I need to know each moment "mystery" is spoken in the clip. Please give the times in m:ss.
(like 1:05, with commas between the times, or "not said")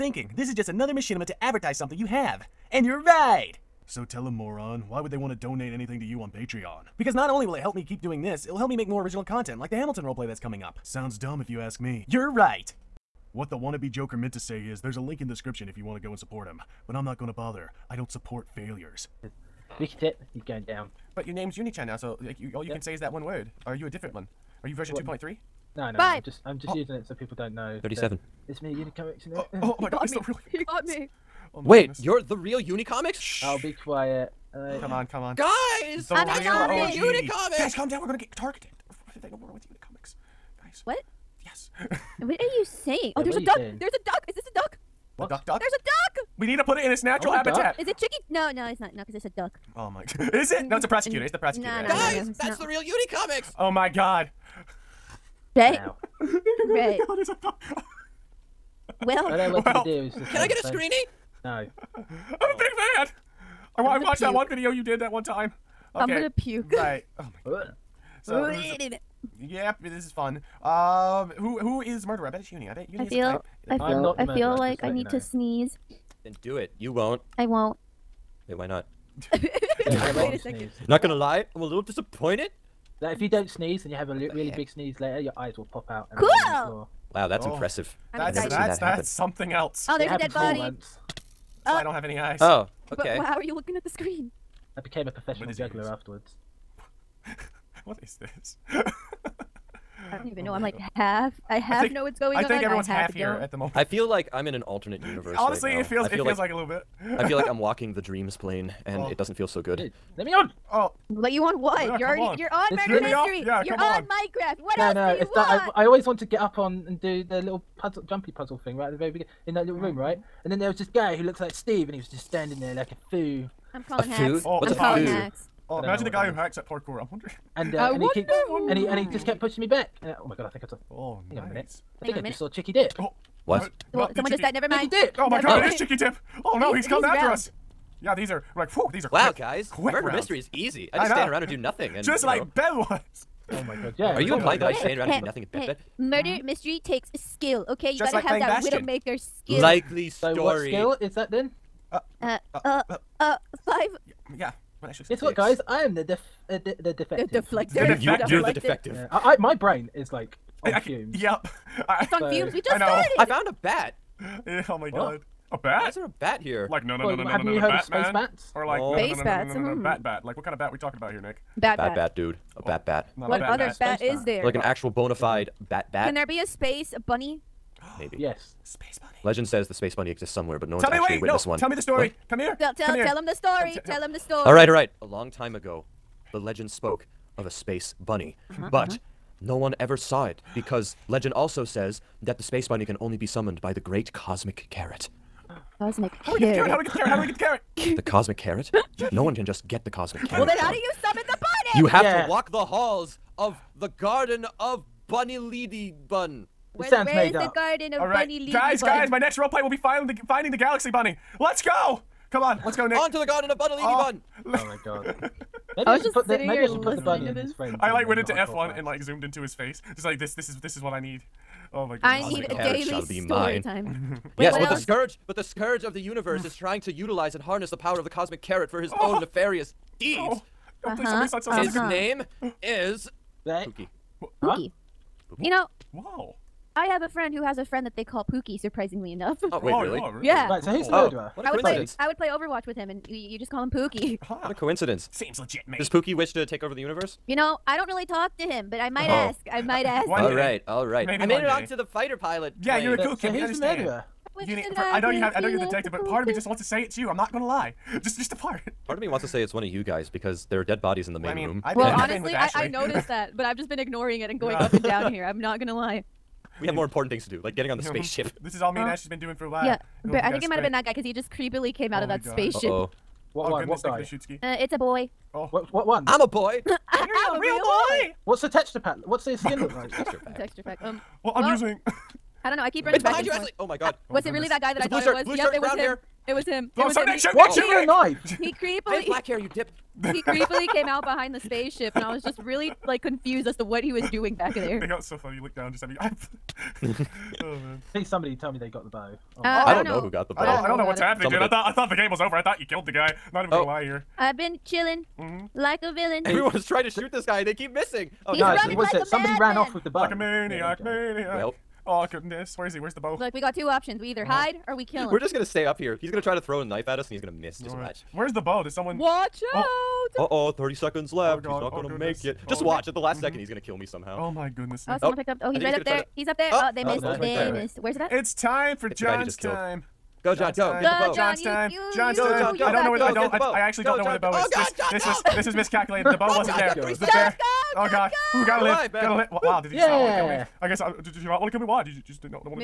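1:53, 2:20, 2:26.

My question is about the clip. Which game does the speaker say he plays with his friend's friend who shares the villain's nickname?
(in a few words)
Overwatch.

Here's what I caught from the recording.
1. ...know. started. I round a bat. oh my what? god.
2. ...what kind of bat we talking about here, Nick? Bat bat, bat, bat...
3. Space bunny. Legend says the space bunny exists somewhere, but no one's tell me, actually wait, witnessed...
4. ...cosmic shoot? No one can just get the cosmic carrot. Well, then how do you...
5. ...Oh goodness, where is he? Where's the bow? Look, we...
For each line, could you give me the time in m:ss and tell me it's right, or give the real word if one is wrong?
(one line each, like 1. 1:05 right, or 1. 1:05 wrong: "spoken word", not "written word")
1. 2:42 wrong: "found", not "round"
2. 2:50 right
3. 2:58 right
4. 3:18 wrong: "carrot", not "shoot"
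5. 5:11 right.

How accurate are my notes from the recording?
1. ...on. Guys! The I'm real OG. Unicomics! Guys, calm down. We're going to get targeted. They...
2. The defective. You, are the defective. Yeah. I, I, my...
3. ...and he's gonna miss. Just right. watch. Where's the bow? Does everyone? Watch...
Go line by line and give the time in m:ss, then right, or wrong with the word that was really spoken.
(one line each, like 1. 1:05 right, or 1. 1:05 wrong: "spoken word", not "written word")
1. 0:35 right
2. 2:37 right
3. 5:17 wrong: "someone", not "everyone".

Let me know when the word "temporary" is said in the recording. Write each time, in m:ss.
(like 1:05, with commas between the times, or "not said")
not said.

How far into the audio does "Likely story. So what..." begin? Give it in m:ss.
2:29.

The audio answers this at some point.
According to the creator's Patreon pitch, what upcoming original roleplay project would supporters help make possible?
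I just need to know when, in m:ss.
0:09.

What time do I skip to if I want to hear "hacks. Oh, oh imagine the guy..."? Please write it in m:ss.
2:05.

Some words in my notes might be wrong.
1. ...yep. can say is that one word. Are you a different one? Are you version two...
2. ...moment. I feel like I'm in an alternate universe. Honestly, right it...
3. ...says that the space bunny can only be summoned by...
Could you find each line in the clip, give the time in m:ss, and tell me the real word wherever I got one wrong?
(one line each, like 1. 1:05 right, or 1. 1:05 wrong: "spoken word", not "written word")
1. 0:22 right
2. 1:43 right
3. 3:11 right.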